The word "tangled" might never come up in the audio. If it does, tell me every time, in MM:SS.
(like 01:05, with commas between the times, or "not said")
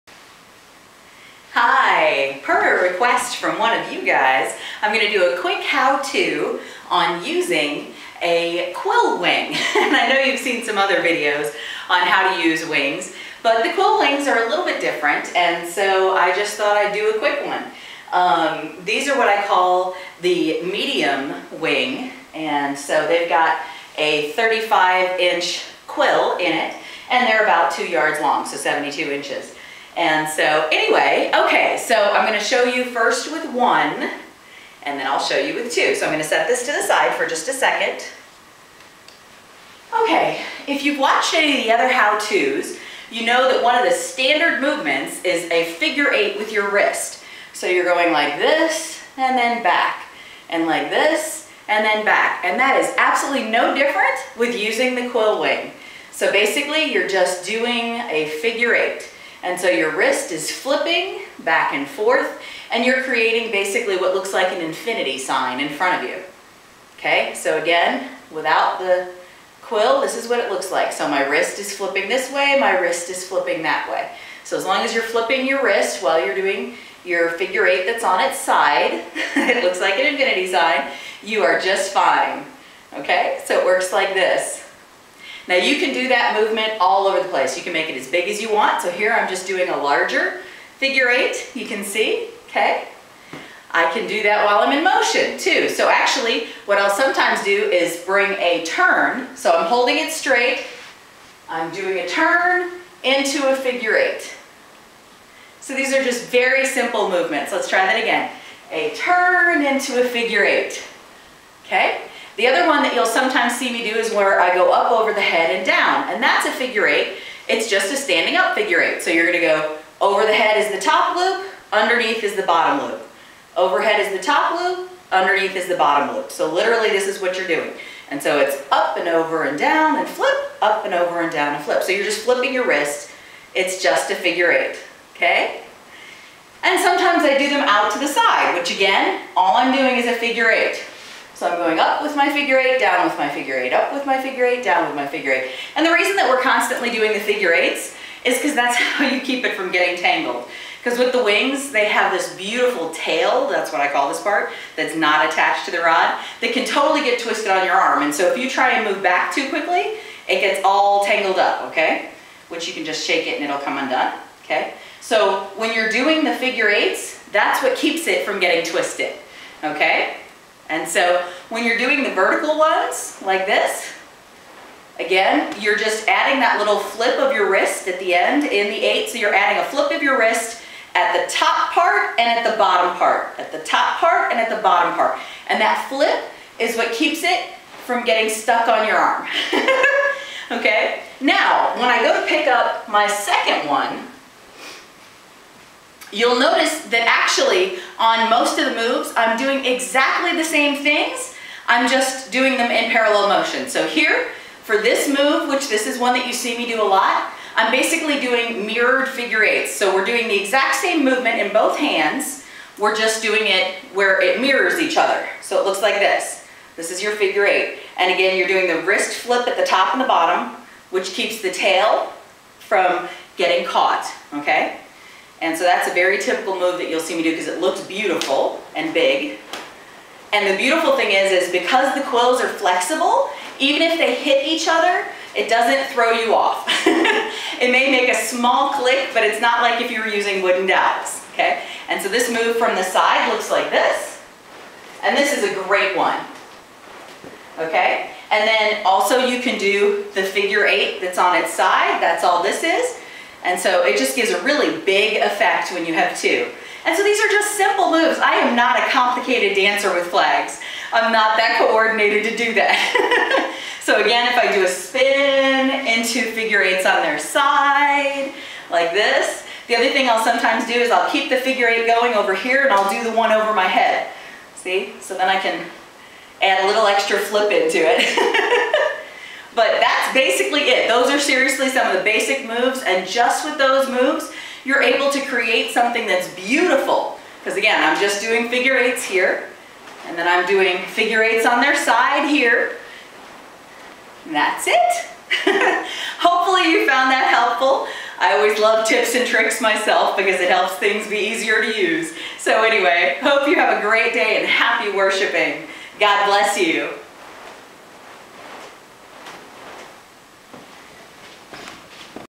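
02:29, 02:41.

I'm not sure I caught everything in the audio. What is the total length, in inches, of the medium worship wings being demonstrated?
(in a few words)
72 inches.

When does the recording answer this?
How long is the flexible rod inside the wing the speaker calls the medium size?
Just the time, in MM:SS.
00:24.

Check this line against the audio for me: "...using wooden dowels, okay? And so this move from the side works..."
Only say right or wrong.
wrong.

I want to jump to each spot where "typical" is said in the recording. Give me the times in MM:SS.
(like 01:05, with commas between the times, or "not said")
03:46.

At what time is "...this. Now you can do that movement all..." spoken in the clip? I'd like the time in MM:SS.
01:24.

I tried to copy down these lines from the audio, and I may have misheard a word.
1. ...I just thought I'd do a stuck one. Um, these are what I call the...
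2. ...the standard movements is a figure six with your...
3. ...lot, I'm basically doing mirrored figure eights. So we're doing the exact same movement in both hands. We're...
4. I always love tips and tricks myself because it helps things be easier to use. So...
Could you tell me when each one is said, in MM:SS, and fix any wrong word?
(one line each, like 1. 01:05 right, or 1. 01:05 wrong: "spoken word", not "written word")
1. 00:16 wrong: "quick", not "stuck"
2. 00:43 wrong: "eight", not "six"
3. 03:26 right
4. 04:58 right.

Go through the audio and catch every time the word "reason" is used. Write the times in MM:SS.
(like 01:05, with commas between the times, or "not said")
02:25.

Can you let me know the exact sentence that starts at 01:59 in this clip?
So you're gonna go over the head is the top loop, underneath is the bottom loop.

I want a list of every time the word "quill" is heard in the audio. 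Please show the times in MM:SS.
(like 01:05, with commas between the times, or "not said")
00:08, 00:13, 00:25, 00:55, 01:09, 03:52.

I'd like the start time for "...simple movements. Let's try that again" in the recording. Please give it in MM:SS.
01:46.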